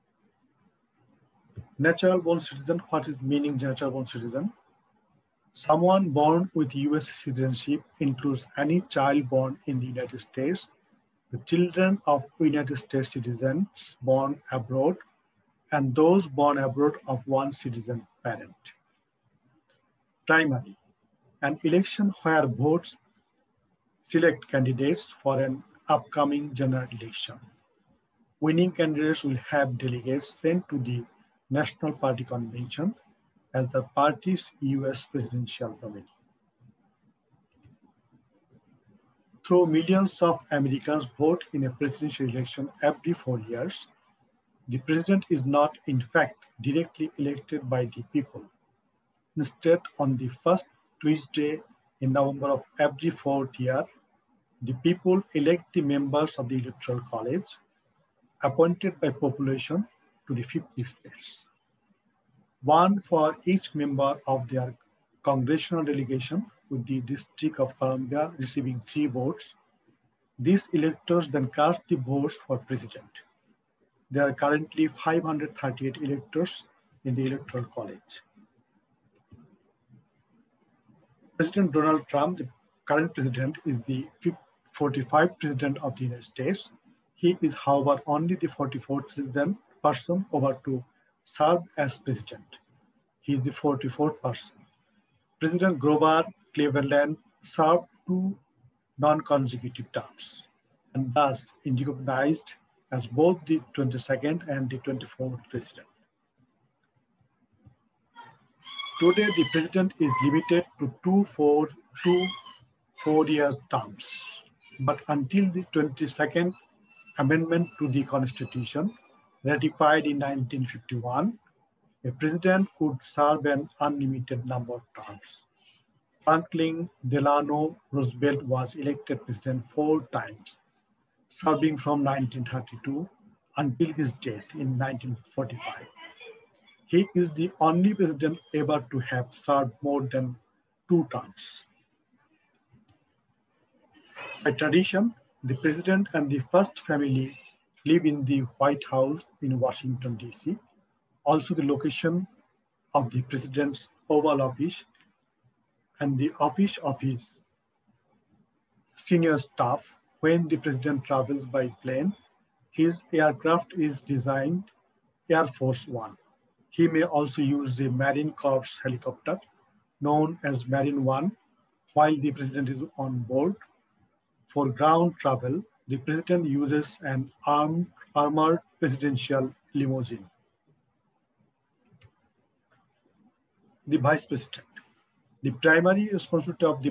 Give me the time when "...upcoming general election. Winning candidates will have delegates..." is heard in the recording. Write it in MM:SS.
00:25.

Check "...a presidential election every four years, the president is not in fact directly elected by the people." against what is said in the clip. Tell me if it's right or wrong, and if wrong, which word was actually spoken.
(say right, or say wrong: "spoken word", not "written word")
right.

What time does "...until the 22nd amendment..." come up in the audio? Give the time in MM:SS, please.
01:55.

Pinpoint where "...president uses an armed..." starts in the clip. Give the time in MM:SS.
02:55.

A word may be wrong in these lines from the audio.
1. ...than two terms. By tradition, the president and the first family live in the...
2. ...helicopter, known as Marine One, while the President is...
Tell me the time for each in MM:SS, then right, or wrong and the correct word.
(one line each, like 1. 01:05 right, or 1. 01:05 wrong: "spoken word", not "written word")
1. 02:20 right
2. 02:48 right.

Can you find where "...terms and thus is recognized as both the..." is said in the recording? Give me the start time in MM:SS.
01:39.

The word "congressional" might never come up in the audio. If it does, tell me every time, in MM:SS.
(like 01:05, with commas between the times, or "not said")
01:05.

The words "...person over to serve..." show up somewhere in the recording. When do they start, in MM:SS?
01:29.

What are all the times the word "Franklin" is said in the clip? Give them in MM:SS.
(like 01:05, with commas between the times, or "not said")
02:06.